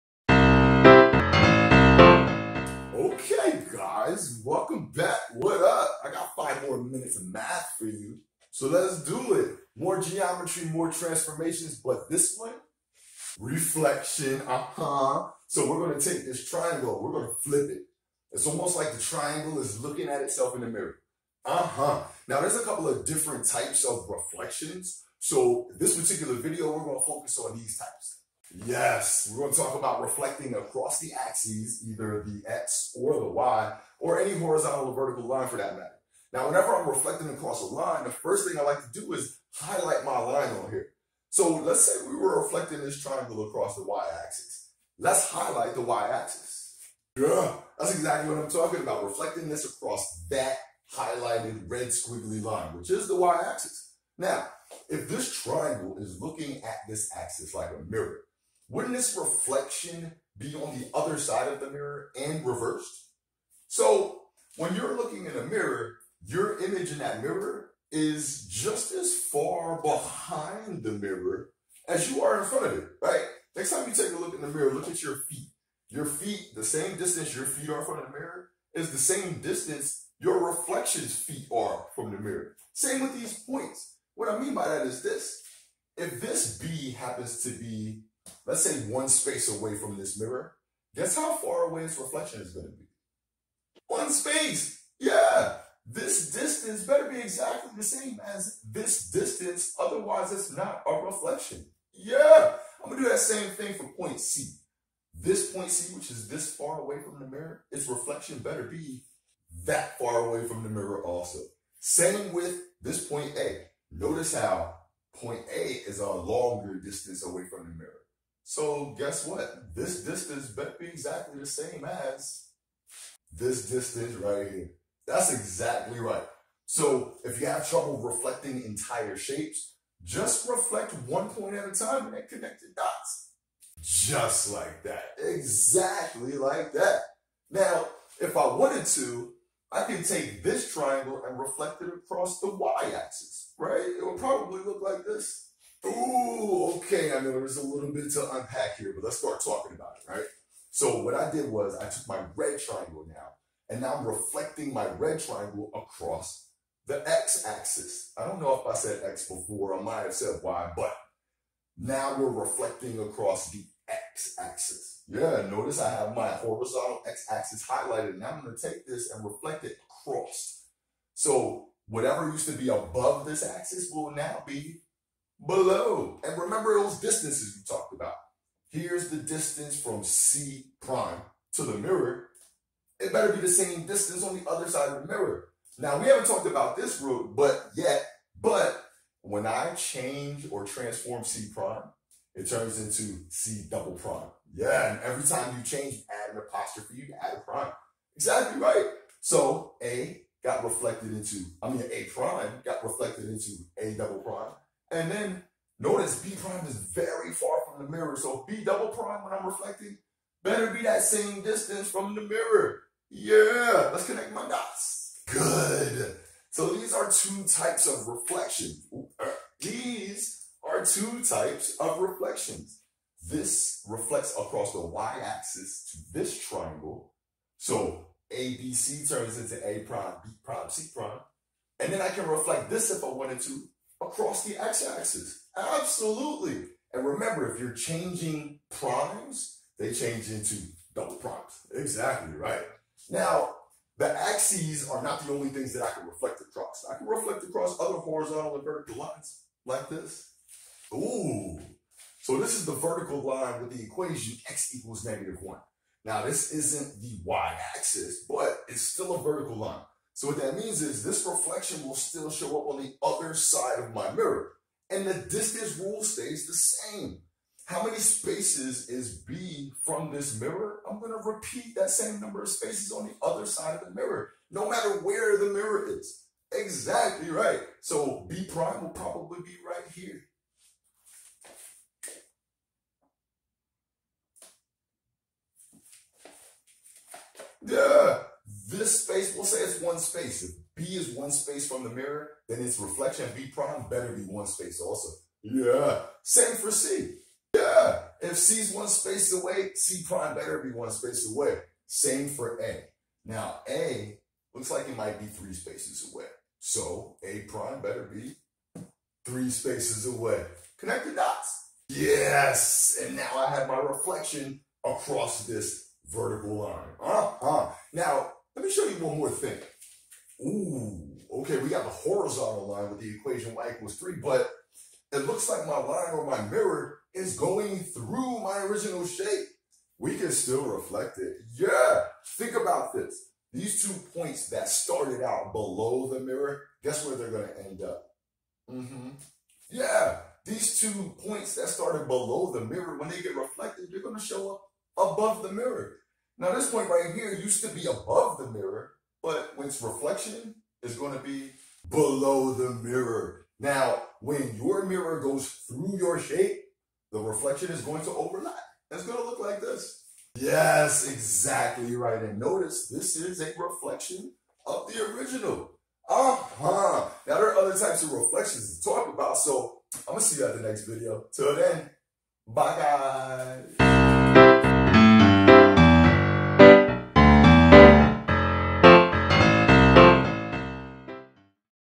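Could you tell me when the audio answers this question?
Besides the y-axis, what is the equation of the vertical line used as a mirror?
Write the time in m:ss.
4:14.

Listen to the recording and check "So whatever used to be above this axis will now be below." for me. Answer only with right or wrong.
right.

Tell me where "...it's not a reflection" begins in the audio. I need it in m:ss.
1:40.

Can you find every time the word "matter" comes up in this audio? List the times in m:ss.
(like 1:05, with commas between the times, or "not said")
0:35, 4:34.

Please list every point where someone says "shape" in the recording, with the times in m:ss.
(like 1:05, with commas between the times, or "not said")
2:09, 5:29, 5:56.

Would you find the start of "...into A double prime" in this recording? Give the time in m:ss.
3:23.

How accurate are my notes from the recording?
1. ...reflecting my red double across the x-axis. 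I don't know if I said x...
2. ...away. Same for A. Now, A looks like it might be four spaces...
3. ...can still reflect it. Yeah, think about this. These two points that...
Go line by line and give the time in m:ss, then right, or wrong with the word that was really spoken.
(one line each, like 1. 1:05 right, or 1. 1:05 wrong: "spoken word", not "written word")
1. 2:34 wrong: "triangle", not "double"
2. 5:01 wrong: "three", not "four"
3. 5:30 right.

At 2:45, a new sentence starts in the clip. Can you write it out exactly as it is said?
Yeah, notice I have my horizontal x-axis highlighted.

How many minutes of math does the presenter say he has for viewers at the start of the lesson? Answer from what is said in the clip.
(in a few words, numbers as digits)
5.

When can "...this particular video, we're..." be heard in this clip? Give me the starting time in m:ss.
0:25.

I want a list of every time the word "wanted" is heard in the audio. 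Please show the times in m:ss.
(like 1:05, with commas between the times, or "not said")
2:18, 3:53.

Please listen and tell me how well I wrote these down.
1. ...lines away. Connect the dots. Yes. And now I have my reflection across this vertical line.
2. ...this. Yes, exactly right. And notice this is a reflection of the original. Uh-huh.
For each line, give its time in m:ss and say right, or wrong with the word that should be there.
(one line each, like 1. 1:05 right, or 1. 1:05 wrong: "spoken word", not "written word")
1. 5:09 wrong: "spaces", not "lines"
2. 5:59 right.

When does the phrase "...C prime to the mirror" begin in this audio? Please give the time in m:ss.
3:00.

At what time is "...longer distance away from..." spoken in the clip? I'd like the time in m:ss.
1:56.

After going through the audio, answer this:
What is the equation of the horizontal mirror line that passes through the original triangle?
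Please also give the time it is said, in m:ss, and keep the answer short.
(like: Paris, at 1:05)
y = 3, at 5:23.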